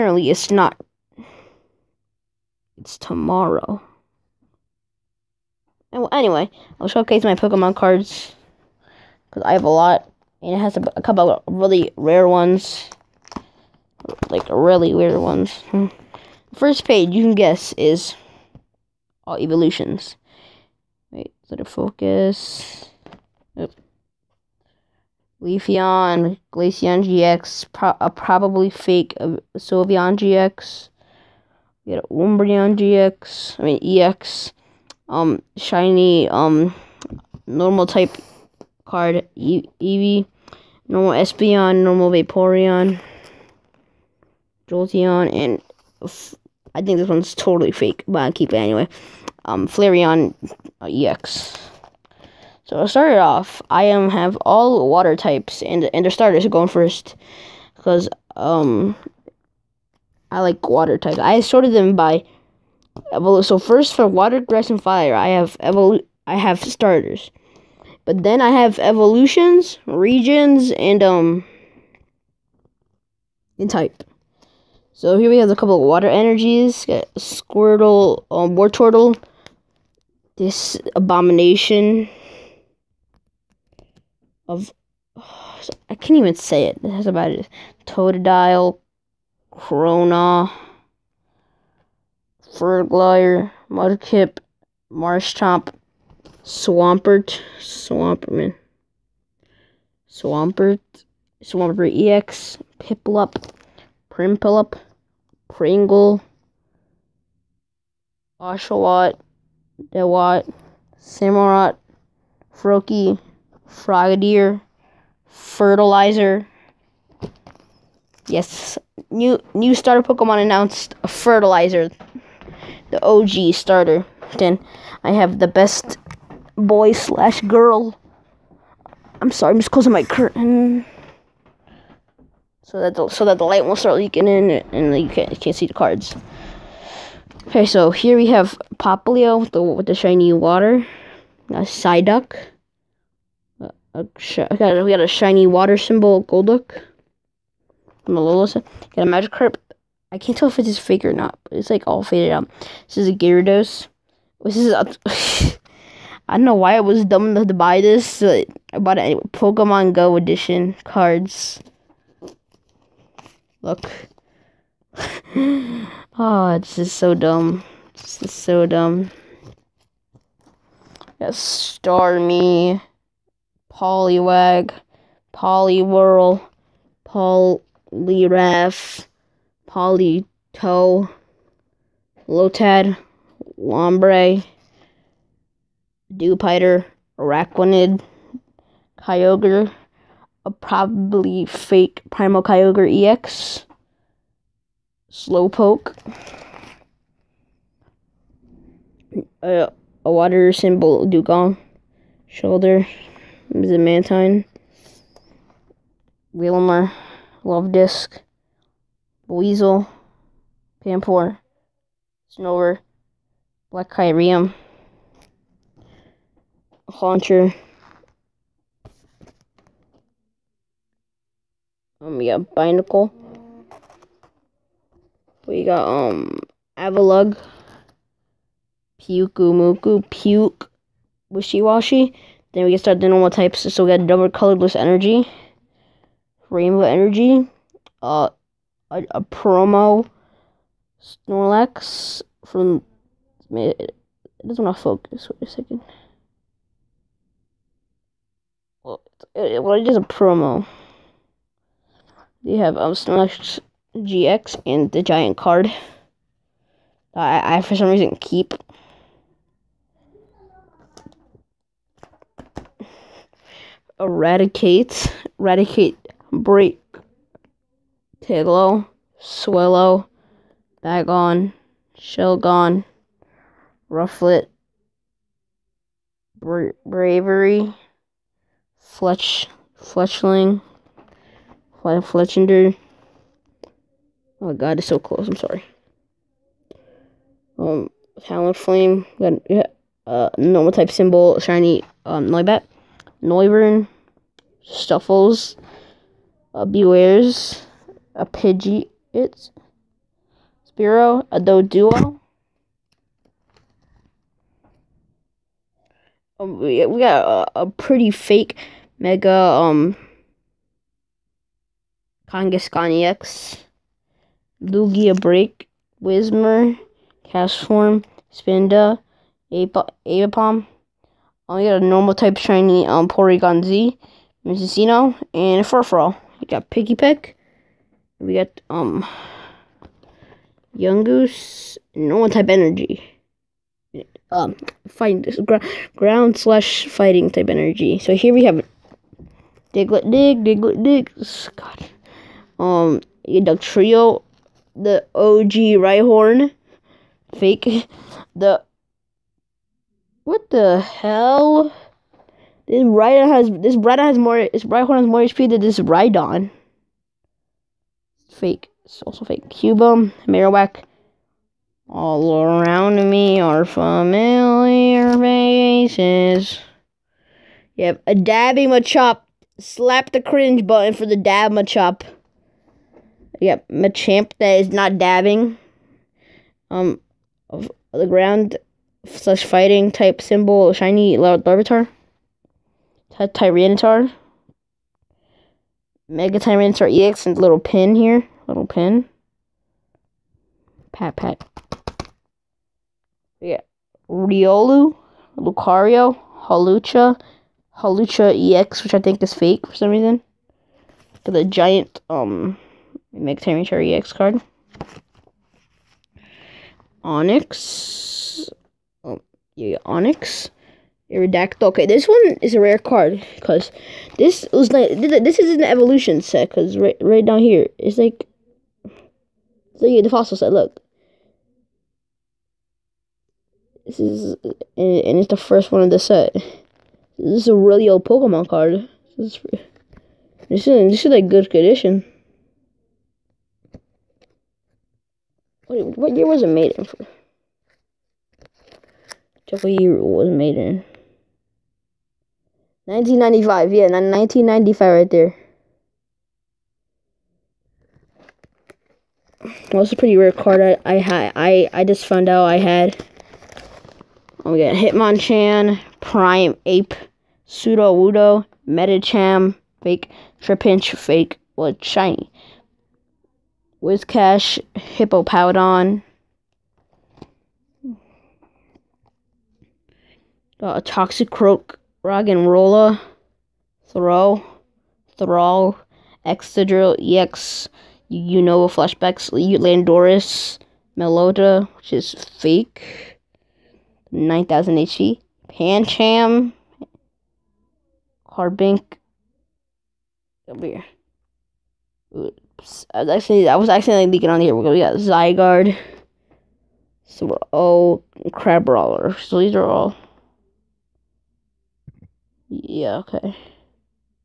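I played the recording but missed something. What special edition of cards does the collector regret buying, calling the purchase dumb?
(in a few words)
Pokemon Go edition.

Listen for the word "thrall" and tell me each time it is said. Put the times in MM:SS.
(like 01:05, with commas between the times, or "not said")
07:55.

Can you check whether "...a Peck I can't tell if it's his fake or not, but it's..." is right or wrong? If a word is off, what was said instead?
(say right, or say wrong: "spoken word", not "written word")
wrong: "Magikarp", not "Peck".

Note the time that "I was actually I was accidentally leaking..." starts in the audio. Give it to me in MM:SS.
08:12.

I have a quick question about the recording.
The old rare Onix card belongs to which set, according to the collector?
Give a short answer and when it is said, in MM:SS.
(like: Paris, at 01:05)
Fossil set, at 07:00.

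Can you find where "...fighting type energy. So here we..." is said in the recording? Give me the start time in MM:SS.
05:36.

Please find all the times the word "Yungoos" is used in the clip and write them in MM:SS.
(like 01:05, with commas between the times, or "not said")
05:30.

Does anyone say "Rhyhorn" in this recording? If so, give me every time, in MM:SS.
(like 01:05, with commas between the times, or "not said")
05:45, 05:54.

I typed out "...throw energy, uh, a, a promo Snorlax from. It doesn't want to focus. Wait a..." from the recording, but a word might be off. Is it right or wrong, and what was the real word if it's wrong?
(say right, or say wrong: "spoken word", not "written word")
wrong: "rainbow", not "throw".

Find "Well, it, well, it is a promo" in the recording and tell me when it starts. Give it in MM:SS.
04:08.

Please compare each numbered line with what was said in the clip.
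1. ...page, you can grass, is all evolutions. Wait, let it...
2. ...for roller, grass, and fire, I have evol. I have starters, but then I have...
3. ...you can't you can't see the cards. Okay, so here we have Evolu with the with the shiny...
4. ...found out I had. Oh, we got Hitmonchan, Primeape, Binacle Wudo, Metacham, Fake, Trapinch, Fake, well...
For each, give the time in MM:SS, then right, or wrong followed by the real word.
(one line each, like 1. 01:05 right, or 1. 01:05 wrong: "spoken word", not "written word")
1. 00:16 wrong: "guess", not "grass"
2. 01:03 wrong: "water", not "roller"
3. 02:14 wrong: "Popplio", not "Evolu"
4. 07:32 wrong: "Pseudo", not "Binacle".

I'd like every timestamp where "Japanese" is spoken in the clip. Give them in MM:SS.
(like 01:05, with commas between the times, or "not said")
not said.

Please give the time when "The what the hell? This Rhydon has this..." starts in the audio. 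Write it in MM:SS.
05:48.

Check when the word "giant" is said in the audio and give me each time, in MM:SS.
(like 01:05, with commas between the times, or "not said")
04:15, 06:41.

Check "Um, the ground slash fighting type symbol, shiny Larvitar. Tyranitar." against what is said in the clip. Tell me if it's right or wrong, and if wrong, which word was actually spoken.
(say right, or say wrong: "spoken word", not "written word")
right.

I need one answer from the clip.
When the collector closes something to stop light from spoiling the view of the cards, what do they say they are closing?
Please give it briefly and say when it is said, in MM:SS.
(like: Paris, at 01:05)
Curtain, at 02:10.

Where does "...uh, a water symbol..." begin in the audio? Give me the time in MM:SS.
03:19.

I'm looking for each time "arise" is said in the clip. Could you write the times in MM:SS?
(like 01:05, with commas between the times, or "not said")
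not said.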